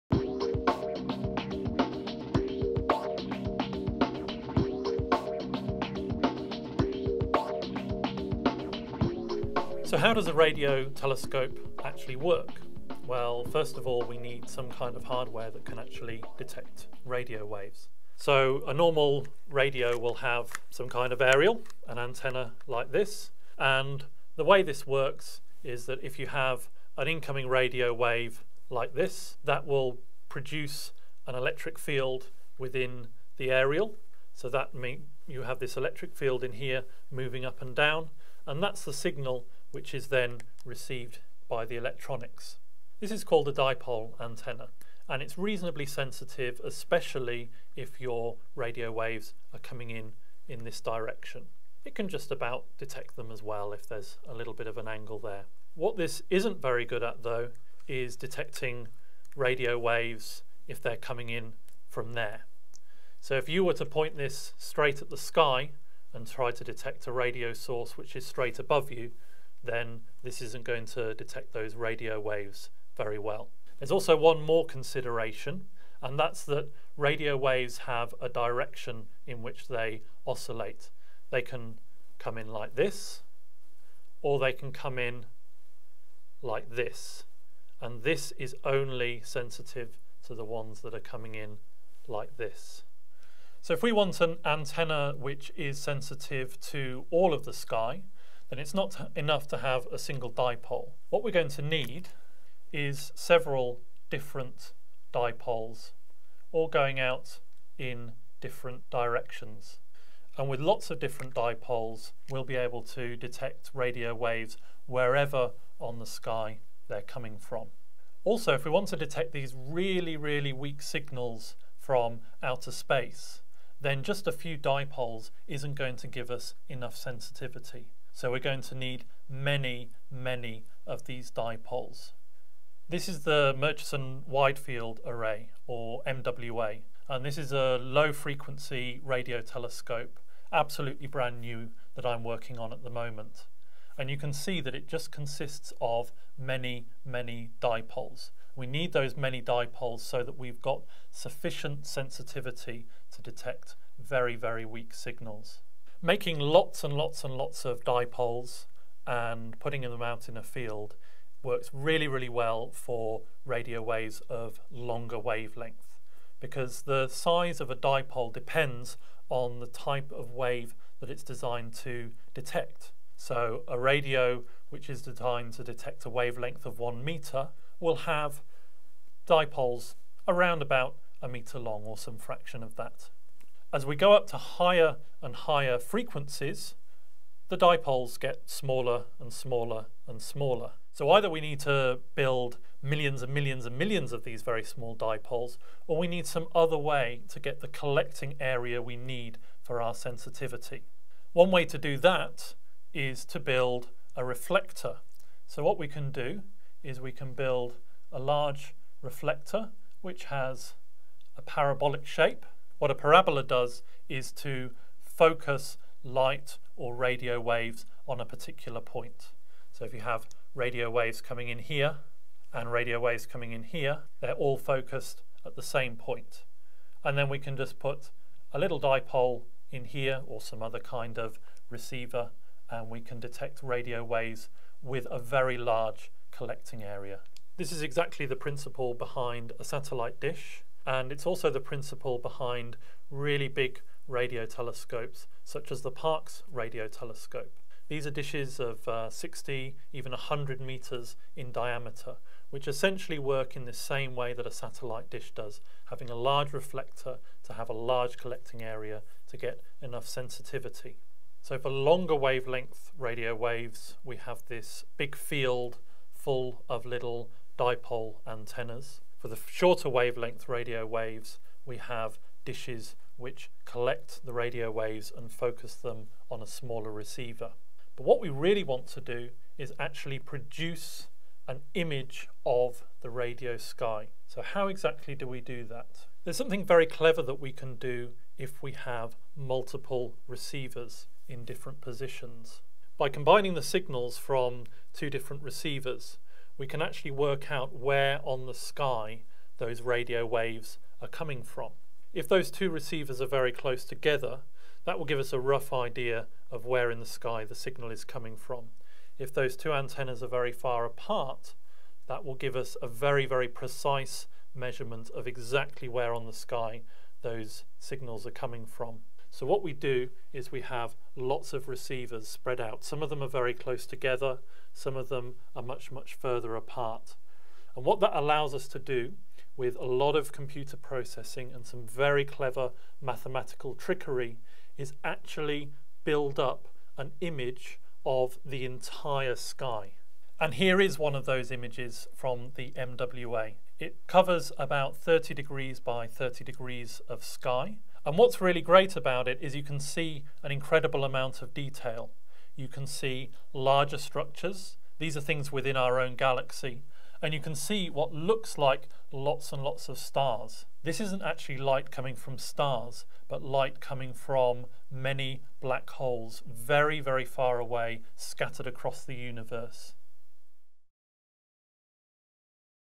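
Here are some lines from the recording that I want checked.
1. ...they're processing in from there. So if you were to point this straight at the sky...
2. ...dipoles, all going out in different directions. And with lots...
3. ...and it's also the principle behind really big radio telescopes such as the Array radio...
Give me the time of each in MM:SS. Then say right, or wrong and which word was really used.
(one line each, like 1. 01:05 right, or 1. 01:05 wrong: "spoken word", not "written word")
1. 01:00 wrong: "coming", not "processing"
2. 01:45 right
3. 04:00 wrong: "Parkes", not "Array".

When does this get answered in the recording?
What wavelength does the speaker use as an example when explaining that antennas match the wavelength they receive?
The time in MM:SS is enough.
02:56.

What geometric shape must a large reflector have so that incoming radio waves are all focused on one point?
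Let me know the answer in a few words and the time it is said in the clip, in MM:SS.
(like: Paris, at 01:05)
parabolic, at 03:31.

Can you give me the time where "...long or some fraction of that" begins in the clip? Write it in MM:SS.
03:01.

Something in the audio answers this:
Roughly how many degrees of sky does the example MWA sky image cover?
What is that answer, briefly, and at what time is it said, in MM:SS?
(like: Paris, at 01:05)
30 by 30 degrees, at 05:44.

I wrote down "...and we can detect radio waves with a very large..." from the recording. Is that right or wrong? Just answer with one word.
right.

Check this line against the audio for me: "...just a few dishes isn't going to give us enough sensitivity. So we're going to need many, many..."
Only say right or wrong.
wrong.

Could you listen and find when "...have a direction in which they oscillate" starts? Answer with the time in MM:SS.
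01:17.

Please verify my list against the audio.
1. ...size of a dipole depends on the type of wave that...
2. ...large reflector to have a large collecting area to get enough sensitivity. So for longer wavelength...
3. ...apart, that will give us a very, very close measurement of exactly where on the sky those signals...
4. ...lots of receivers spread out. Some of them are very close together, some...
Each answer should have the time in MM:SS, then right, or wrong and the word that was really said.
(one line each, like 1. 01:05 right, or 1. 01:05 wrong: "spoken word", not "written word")
1. 02:47 right
2. 04:16 right
3. 05:10 wrong: "precise", not "close"
4. 05:21 right.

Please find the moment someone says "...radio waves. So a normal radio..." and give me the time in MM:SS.
00:17.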